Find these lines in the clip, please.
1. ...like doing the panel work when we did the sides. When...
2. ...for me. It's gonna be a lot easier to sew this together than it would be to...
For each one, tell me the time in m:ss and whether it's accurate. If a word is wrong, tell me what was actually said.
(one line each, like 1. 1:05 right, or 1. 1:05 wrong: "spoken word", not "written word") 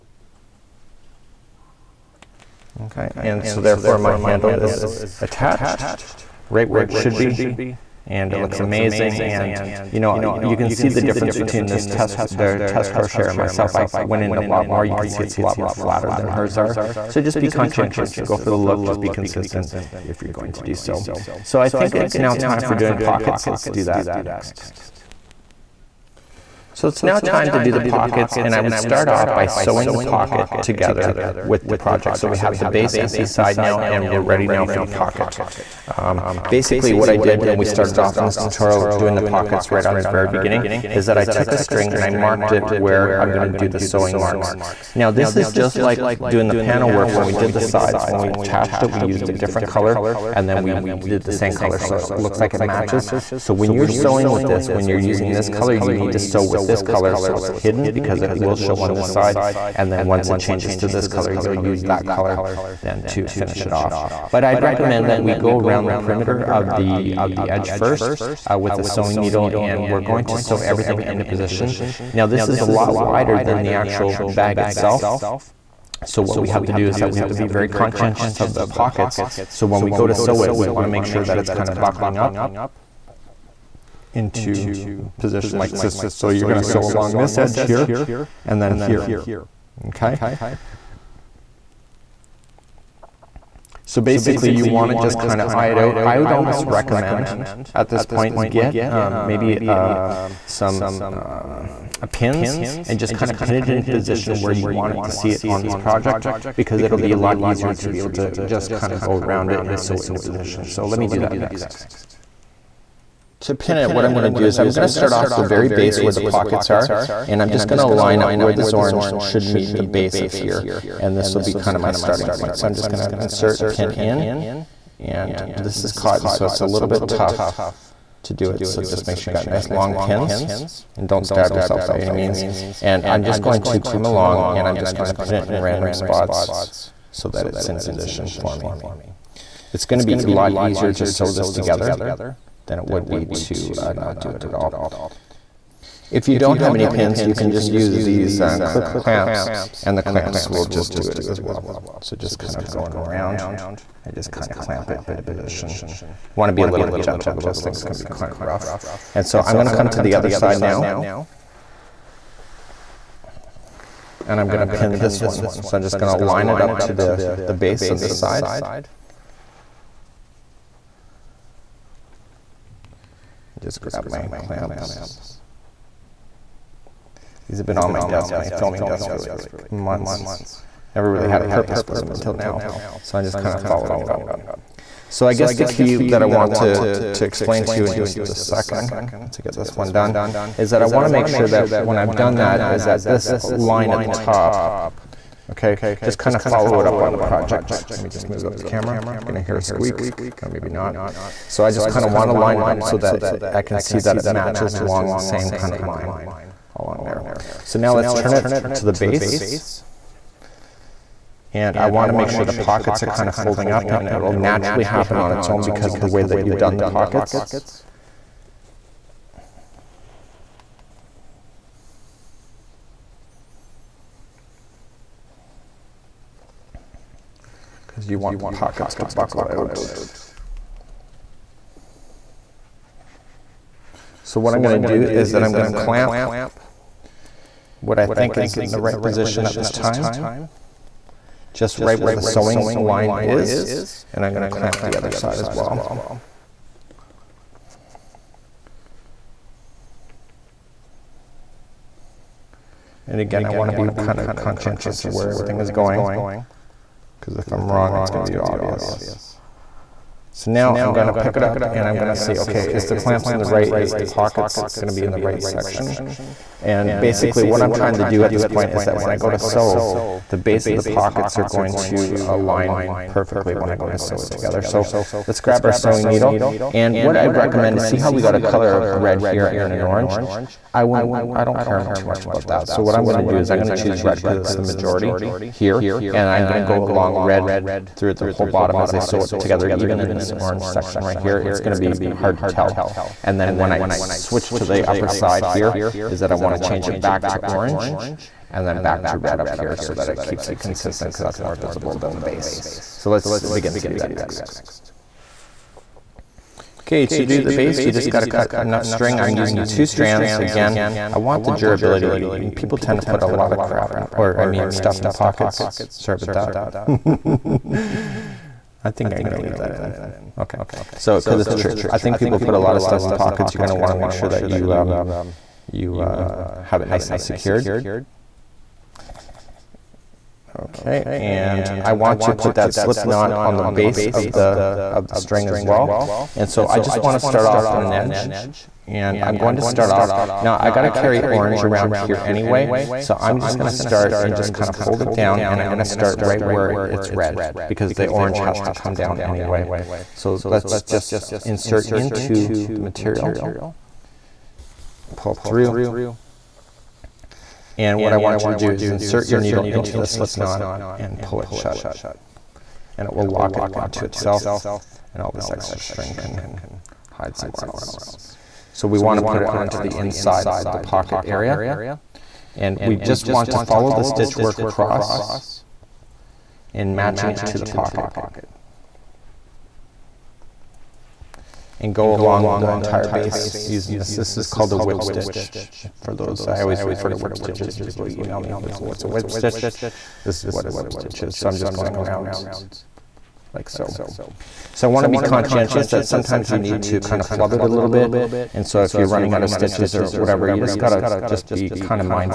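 1. 0:45 right
2. 2:18 right.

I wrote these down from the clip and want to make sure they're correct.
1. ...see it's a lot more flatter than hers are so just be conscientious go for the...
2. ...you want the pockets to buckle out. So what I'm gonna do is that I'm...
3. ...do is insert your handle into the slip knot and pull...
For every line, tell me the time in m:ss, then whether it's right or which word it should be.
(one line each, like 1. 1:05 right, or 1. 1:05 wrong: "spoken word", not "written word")
1. 0:15 right
2. 3:48 right
3. 5:58 wrong: "needle", not "handle".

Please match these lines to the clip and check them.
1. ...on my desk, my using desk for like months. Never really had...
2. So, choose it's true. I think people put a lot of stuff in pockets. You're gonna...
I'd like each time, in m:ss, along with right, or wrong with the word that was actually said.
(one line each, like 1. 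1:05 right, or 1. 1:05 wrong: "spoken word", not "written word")
1. 2:57 wrong: "filming", not "using"
2. 5:20 wrong: "cause", not "choose".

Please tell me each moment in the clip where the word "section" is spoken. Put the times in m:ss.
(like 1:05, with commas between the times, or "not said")
4:25, 4:50.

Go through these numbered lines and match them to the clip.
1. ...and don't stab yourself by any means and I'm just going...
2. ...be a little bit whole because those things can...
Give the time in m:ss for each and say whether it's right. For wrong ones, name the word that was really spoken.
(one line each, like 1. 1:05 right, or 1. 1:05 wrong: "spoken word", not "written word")
1. 2:10 right
2. 2:36 wrong: "gentle", not "whole".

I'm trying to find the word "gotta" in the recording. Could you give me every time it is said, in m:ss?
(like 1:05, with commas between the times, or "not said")
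5:08, 5:40, 6:40.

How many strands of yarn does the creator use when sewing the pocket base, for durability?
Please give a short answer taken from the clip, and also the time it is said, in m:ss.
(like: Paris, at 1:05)
2, at 5:09.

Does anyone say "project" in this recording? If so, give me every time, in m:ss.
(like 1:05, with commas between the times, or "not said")
0:31, 1:45, 3:17.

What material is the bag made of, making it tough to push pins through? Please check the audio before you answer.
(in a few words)
cotton.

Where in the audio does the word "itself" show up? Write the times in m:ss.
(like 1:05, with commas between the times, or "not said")
1:14, 6:04.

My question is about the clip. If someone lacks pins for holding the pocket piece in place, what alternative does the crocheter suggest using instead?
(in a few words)
clip clamps.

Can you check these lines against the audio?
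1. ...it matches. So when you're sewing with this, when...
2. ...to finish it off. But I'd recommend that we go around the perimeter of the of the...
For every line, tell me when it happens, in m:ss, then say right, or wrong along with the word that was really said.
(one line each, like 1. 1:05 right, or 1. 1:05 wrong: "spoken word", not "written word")
1. 0:52 right
2. 1:03 right.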